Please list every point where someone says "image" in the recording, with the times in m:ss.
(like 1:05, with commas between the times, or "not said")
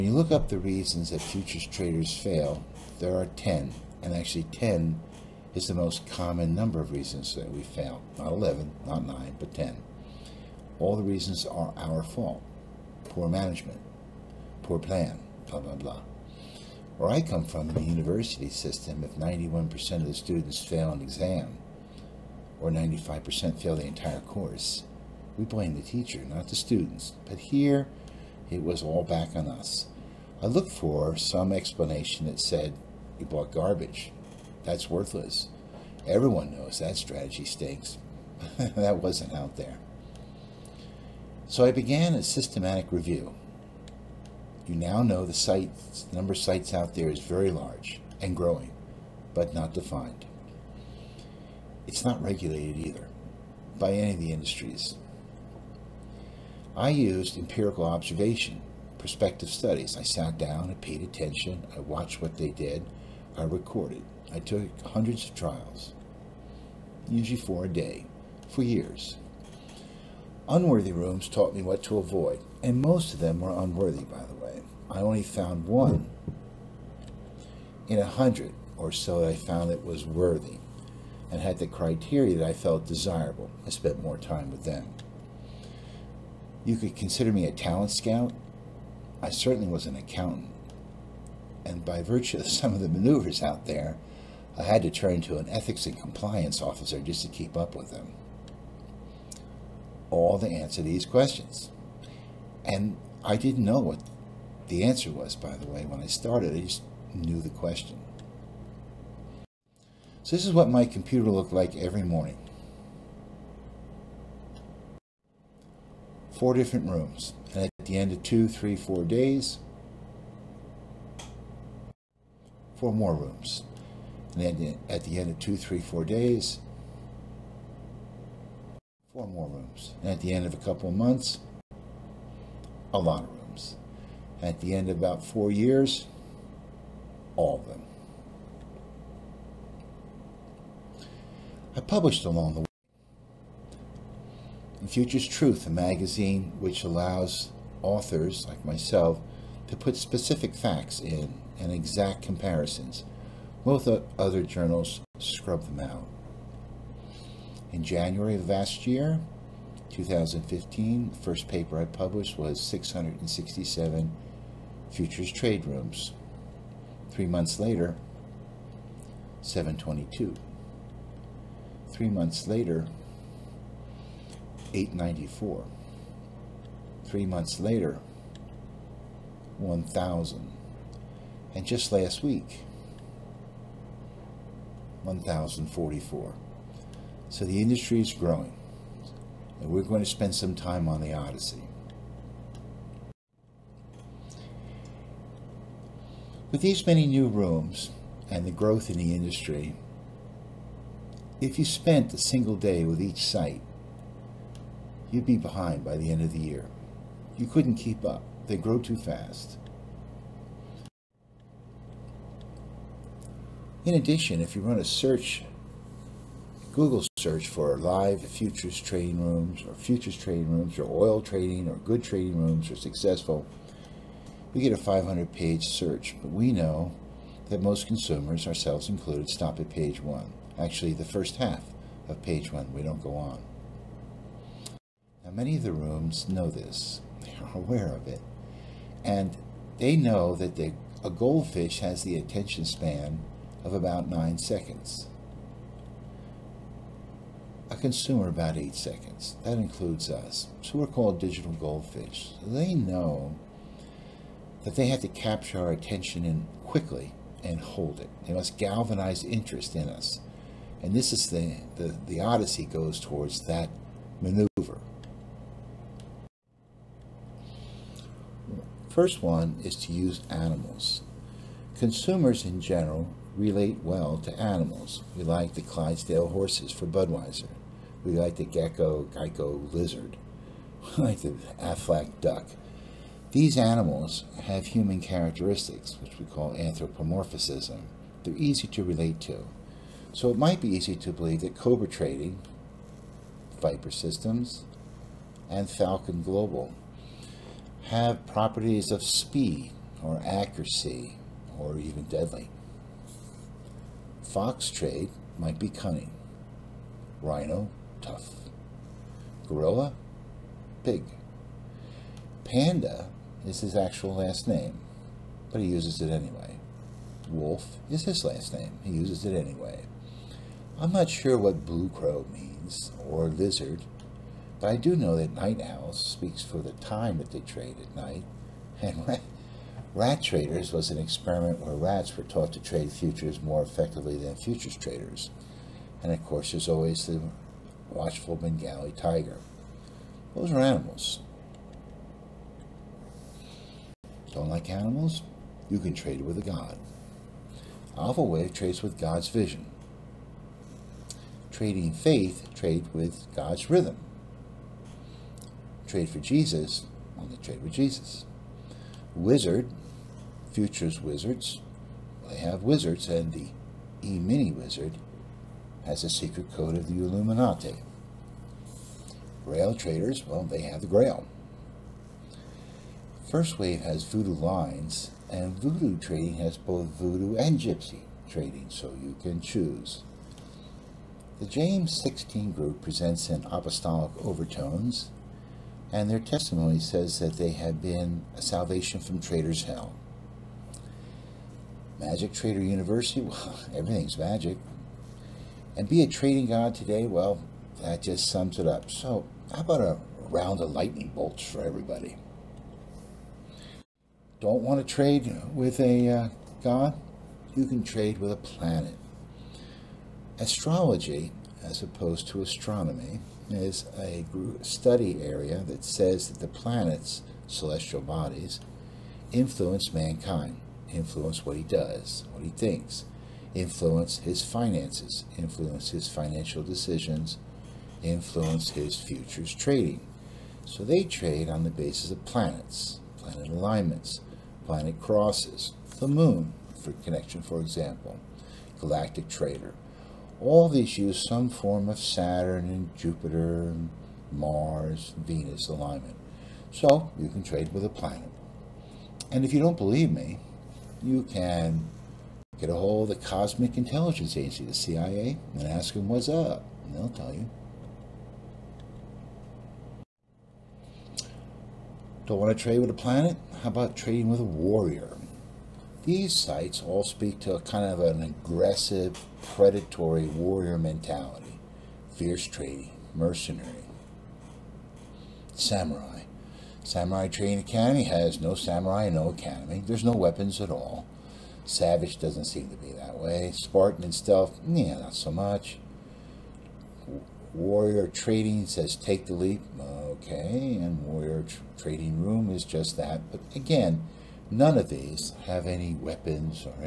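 not said.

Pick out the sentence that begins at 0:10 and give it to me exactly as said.
All the reasons are our fault.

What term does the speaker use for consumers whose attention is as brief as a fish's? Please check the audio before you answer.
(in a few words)
digital goldfish.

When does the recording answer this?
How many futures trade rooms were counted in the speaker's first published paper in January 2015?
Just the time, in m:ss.
2:42.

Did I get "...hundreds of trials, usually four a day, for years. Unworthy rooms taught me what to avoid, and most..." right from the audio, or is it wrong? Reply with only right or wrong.
right.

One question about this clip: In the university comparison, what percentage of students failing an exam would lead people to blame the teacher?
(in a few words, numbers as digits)
91%.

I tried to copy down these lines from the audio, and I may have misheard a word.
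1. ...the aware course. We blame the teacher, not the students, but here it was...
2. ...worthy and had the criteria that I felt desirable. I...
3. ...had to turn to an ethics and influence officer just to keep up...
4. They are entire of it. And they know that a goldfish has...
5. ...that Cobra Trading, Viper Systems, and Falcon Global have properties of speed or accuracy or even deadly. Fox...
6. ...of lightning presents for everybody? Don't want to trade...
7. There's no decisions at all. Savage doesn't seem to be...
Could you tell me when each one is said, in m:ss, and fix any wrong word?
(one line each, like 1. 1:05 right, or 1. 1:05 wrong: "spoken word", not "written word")
1. 0:23 wrong: "entire", not "aware"
2. 1:20 right
3. 1:34 wrong: "compliance", not "influence"
4. 3:57 wrong: "aware", not "entire"
5. 4:51 right
6. 6:40 wrong: "bolts", not "presents"
7. 7:59 wrong: "weapons", not "decisions".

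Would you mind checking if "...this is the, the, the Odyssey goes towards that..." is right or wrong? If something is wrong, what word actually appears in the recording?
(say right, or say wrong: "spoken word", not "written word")
right.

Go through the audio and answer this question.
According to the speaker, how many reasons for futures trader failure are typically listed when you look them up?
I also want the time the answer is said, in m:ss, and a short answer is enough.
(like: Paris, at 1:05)
10, at 0:02.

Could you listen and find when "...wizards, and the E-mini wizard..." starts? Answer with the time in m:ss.
6:02.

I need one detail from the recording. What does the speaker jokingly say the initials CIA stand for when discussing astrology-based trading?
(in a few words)
Cosmic Intelligence Agency.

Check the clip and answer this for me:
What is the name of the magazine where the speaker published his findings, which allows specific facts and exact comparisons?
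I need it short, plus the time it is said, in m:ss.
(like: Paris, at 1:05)
Futures Truth, at 2:24.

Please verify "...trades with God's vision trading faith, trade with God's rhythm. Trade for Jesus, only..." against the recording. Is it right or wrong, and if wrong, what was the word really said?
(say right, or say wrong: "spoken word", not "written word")
right.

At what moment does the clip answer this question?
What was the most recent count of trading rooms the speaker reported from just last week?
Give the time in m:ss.
3:05.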